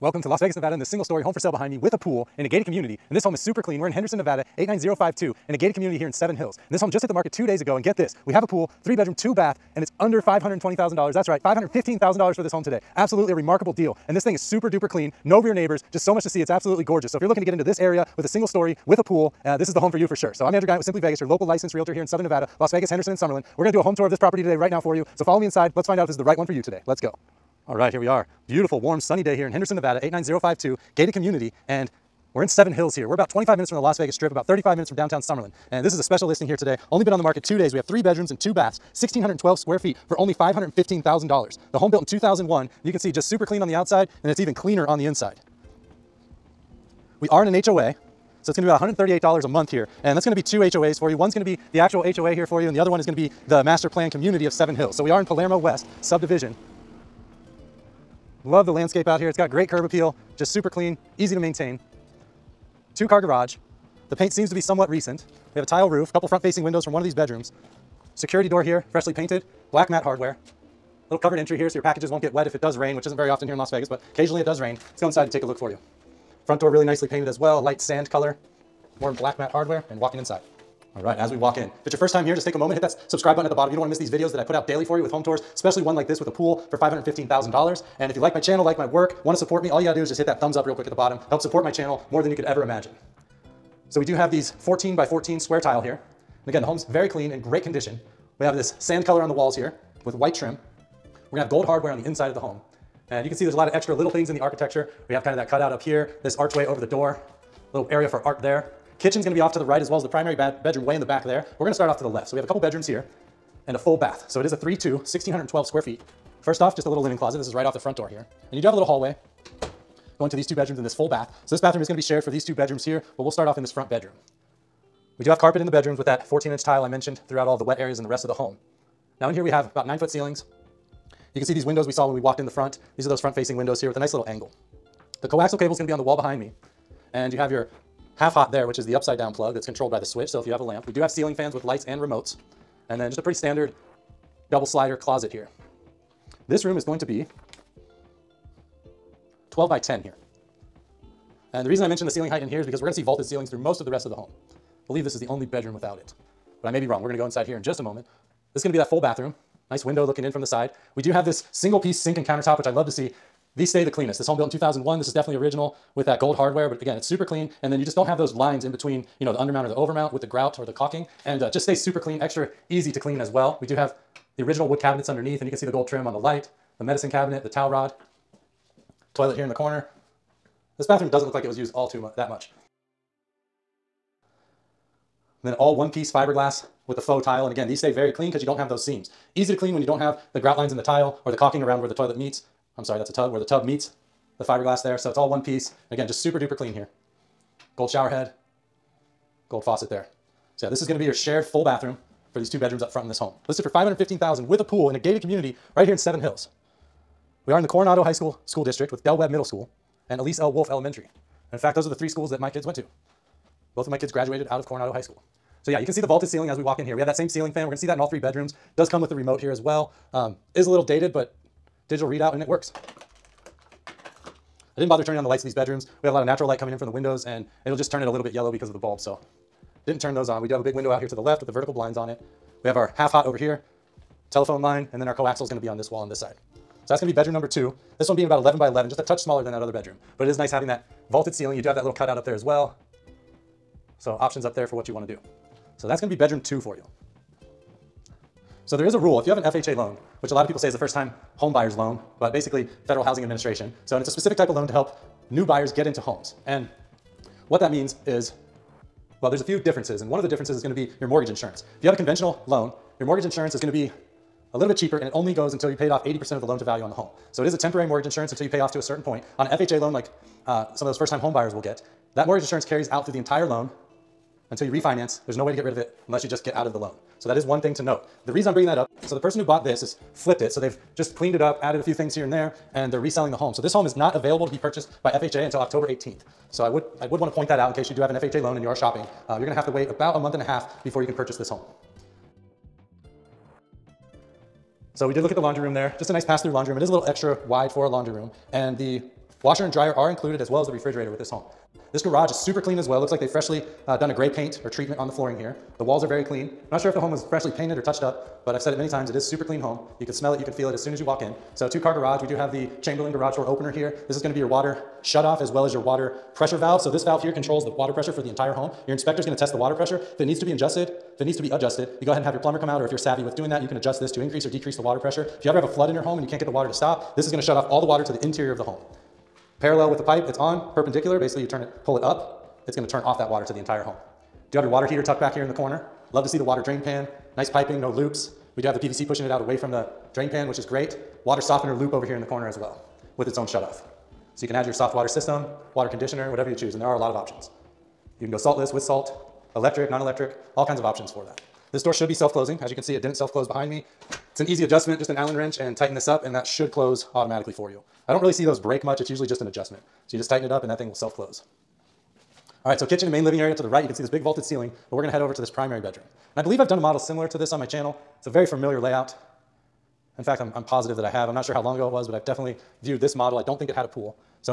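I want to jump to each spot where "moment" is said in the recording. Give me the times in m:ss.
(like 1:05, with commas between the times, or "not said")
1:22, 2:37.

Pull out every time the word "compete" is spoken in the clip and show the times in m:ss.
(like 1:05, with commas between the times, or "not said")
not said.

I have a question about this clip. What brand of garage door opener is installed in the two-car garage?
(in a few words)
Chamberlain.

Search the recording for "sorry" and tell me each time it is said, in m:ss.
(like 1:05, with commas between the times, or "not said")
3:12.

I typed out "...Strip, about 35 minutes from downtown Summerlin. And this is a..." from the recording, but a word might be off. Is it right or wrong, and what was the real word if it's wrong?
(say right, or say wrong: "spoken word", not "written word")
right.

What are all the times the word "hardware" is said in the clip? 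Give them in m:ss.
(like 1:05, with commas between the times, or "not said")
1:10, 1:19, 1:41, 2:46.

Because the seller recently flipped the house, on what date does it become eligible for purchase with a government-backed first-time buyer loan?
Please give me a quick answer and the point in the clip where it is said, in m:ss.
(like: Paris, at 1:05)
October 18th, at 4:45.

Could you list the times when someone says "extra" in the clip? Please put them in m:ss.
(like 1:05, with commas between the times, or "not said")
1:43, 2:52, 4:57.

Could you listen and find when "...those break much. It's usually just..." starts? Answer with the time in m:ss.
5:58.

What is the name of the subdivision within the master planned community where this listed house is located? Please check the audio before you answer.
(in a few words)
Palermo West.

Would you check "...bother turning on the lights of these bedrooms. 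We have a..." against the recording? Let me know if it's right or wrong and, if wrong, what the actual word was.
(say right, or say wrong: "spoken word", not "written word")
right.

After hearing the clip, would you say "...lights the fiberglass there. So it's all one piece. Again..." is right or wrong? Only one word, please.
wrong.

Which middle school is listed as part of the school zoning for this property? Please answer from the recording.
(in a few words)
Del Webb Middle School.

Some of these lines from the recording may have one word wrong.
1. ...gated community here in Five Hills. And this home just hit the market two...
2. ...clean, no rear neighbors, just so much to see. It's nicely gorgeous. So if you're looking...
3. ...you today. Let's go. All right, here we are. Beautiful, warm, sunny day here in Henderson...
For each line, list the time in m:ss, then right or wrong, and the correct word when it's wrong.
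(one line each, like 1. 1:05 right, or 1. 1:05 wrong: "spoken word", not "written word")
1. 0:05 wrong: "Seven", not "Five"
2. 0:14 wrong: "absolutely", not "nicely"
3. 0:26 right.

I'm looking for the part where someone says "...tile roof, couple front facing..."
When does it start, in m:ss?
1:05.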